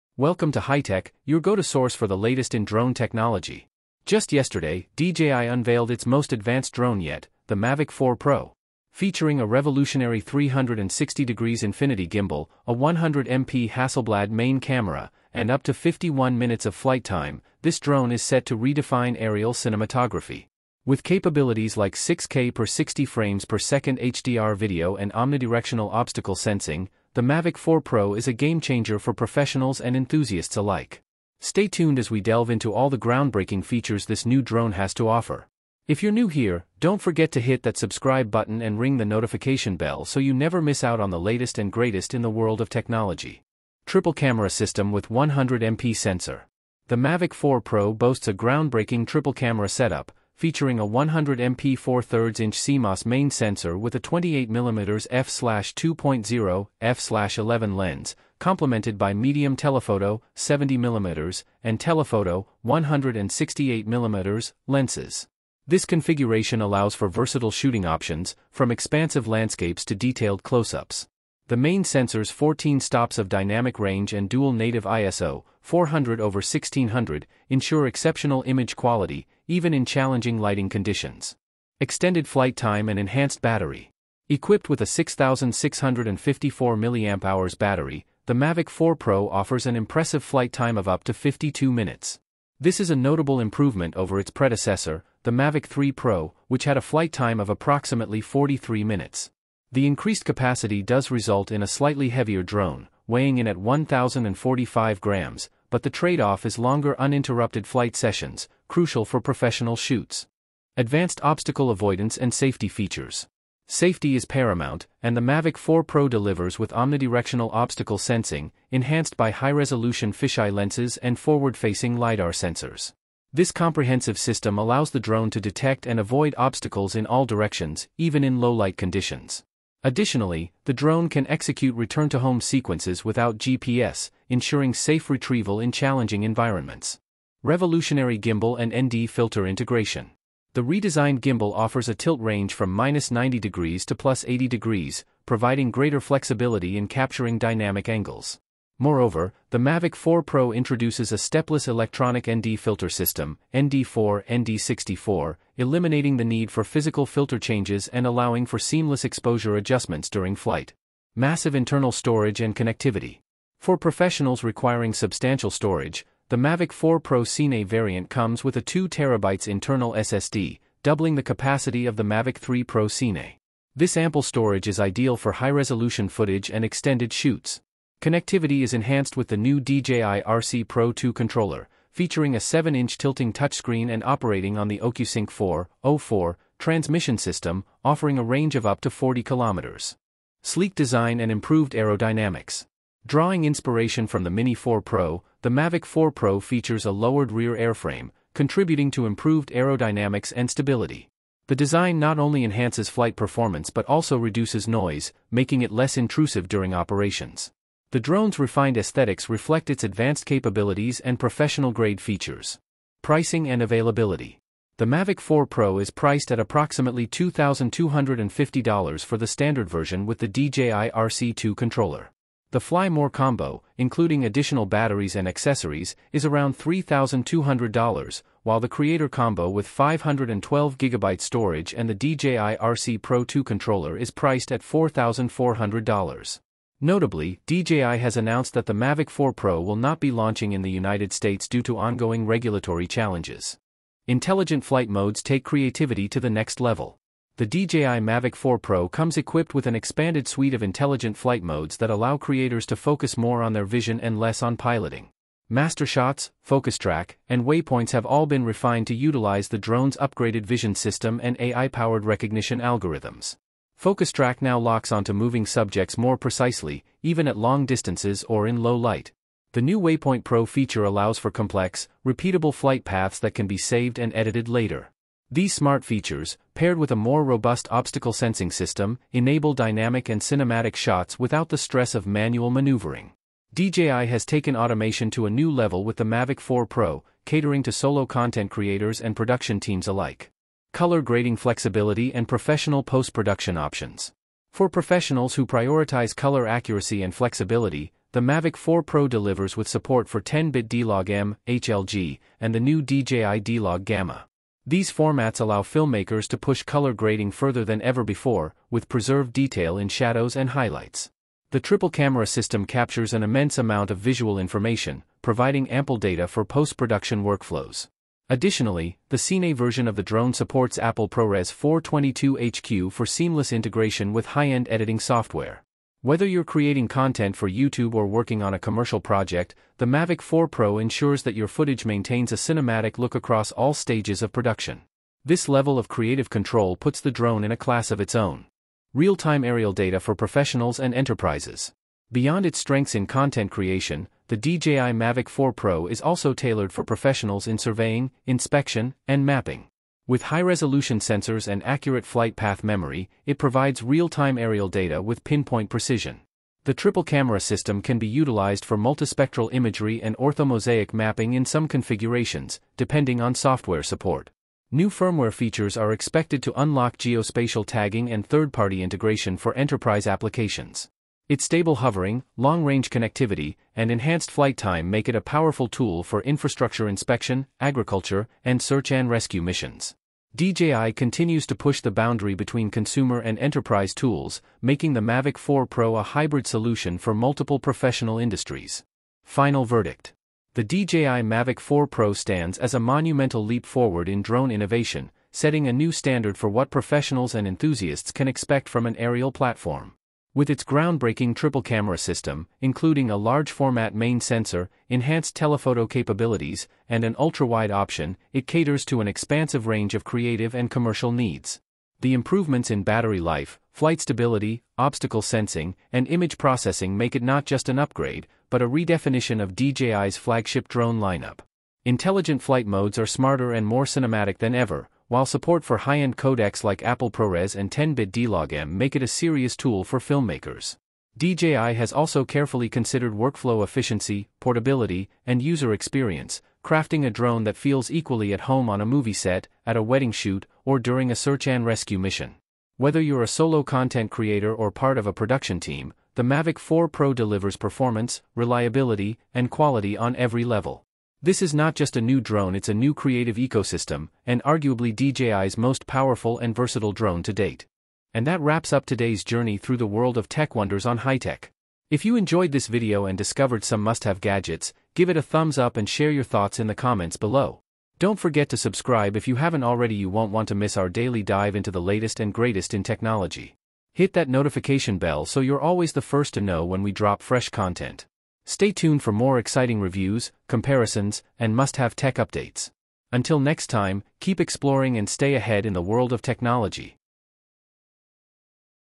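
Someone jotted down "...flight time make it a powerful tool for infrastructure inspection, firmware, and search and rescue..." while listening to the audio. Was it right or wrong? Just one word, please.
wrong.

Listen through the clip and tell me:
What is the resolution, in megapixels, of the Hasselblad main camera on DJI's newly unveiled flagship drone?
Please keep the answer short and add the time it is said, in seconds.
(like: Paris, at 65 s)
100 MP, at 12 s.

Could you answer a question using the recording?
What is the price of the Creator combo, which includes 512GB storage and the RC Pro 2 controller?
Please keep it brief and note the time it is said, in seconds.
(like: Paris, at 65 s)
$4,400, at 234 s.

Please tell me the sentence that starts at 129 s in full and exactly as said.
Additionally, the drone can execute return-to-home sequences without GPS, ensuring safe retrieval in challenging environments.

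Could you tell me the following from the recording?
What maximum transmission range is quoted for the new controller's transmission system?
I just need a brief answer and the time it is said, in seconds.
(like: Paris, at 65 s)
40 kilometers, at 188 s.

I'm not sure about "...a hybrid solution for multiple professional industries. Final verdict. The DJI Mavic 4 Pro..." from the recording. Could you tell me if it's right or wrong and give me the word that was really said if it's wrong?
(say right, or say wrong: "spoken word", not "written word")
right.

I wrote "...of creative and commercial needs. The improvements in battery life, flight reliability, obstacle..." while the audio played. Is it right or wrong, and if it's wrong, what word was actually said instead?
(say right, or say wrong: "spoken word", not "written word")
wrong: "stability", not "reliability".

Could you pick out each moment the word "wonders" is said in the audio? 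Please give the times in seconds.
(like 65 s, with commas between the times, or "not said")
460 s.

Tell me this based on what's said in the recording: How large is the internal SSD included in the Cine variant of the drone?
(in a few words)
2TB.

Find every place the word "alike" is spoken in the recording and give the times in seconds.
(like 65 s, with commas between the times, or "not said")
30 s, 289 s.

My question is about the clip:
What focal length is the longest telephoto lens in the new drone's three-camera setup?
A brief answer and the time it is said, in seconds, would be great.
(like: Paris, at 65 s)
168mm, at 61 s.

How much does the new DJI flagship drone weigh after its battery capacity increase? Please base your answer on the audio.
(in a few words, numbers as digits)
1,045 grams.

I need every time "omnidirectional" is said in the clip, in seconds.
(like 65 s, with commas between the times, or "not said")
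25 s, 116 s.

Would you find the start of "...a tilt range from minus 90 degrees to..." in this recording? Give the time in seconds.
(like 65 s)
141 s.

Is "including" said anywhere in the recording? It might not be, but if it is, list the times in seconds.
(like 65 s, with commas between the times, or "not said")
223 s, 402 s.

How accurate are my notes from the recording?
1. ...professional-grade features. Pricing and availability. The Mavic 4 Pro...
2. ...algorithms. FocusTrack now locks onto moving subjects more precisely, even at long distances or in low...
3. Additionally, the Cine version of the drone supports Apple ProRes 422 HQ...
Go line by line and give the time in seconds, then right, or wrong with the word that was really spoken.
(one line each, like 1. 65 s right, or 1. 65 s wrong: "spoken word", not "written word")
1. 211 s right
2. 262 s right
3. 318 s right.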